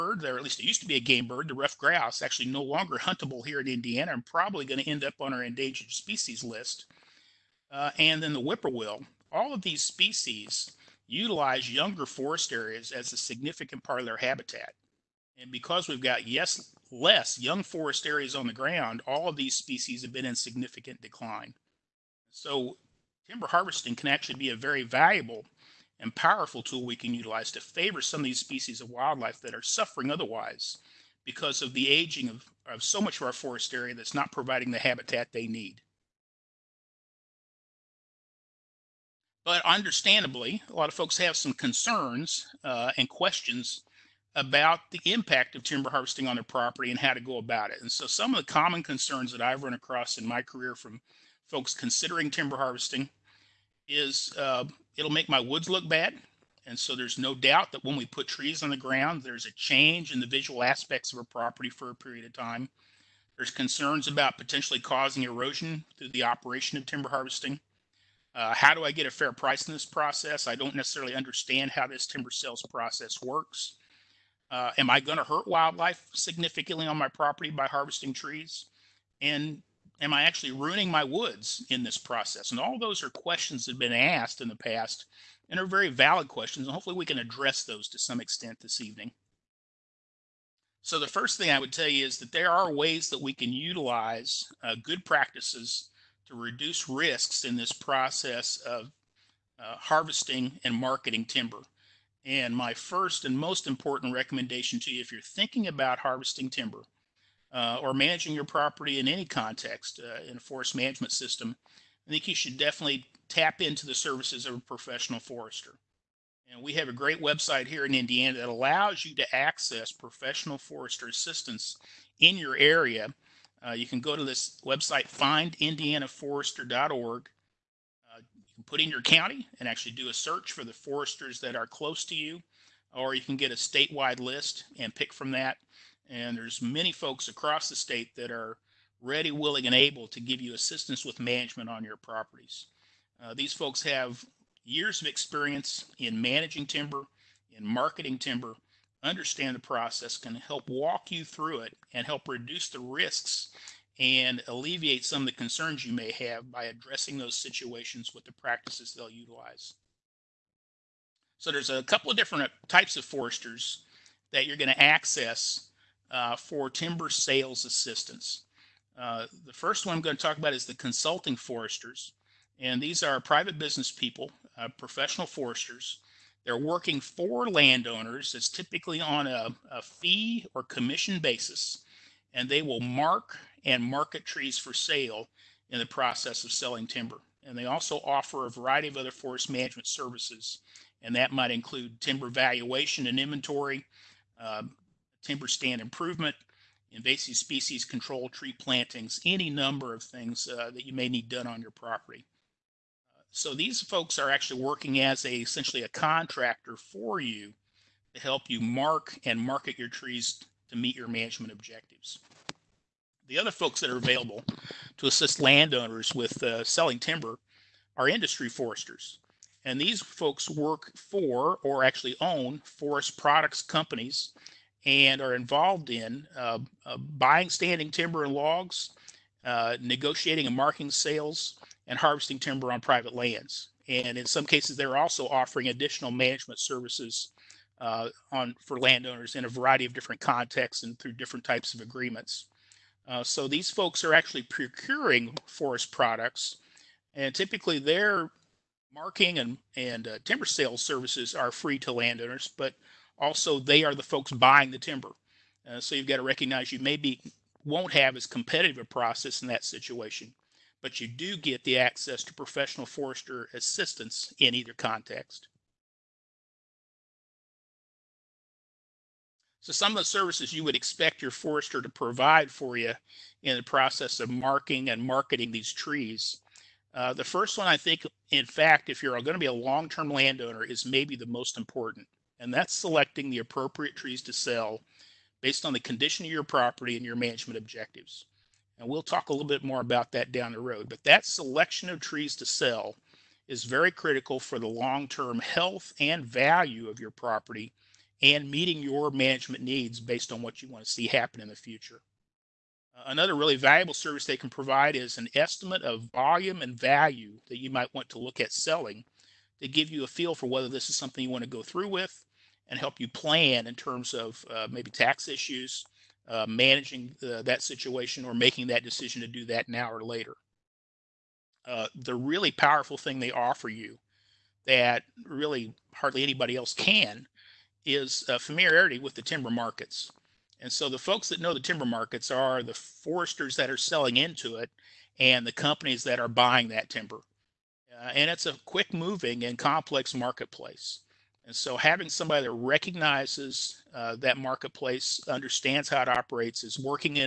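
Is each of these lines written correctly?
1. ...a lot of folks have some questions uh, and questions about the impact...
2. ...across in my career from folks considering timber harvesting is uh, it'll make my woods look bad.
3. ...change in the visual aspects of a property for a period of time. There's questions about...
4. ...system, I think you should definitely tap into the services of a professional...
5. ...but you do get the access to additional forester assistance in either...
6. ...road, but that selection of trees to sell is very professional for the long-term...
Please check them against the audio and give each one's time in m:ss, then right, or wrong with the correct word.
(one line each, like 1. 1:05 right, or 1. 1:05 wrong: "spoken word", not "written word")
1. 0:40 wrong: "concerns", not "questions"
2. 0:49 right
3. 0:59 wrong: "concerns", not "questions"
4. 1:51 right
5. 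4:20 wrong: "professional", not "additional"
6. 4:50 wrong: "critical", not "professional".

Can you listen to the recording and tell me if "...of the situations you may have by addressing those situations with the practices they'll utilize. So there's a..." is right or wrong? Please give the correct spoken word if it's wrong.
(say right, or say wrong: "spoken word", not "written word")
wrong: "concerns", not "situations".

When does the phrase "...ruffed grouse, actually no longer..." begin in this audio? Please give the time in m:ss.
0:01.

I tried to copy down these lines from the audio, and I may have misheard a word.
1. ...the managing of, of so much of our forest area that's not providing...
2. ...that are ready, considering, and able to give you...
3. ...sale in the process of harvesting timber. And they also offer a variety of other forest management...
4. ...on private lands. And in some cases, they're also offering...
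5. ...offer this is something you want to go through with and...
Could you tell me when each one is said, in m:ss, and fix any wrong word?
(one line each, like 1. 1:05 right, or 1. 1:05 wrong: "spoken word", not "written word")
1. 0:31 wrong: "aging", not "managing"
2. 2:18 wrong: "willing", not "considering"
3. 3:04 wrong: "selling", not "harvesting"
4. 3:52 right
5. 5:10 wrong: "whether", not "offer".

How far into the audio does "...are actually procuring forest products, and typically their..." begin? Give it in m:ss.
4:04.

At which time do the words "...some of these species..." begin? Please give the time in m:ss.
0:27.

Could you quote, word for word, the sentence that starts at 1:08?
Uh, how do I get a fair price in this process?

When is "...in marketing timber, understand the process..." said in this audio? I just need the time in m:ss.
2:27.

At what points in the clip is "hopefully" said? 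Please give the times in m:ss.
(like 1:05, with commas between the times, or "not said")
1:26.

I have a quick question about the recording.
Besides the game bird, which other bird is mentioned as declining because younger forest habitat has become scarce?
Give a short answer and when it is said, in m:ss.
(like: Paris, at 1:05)
Whippoorwill, at 0:08.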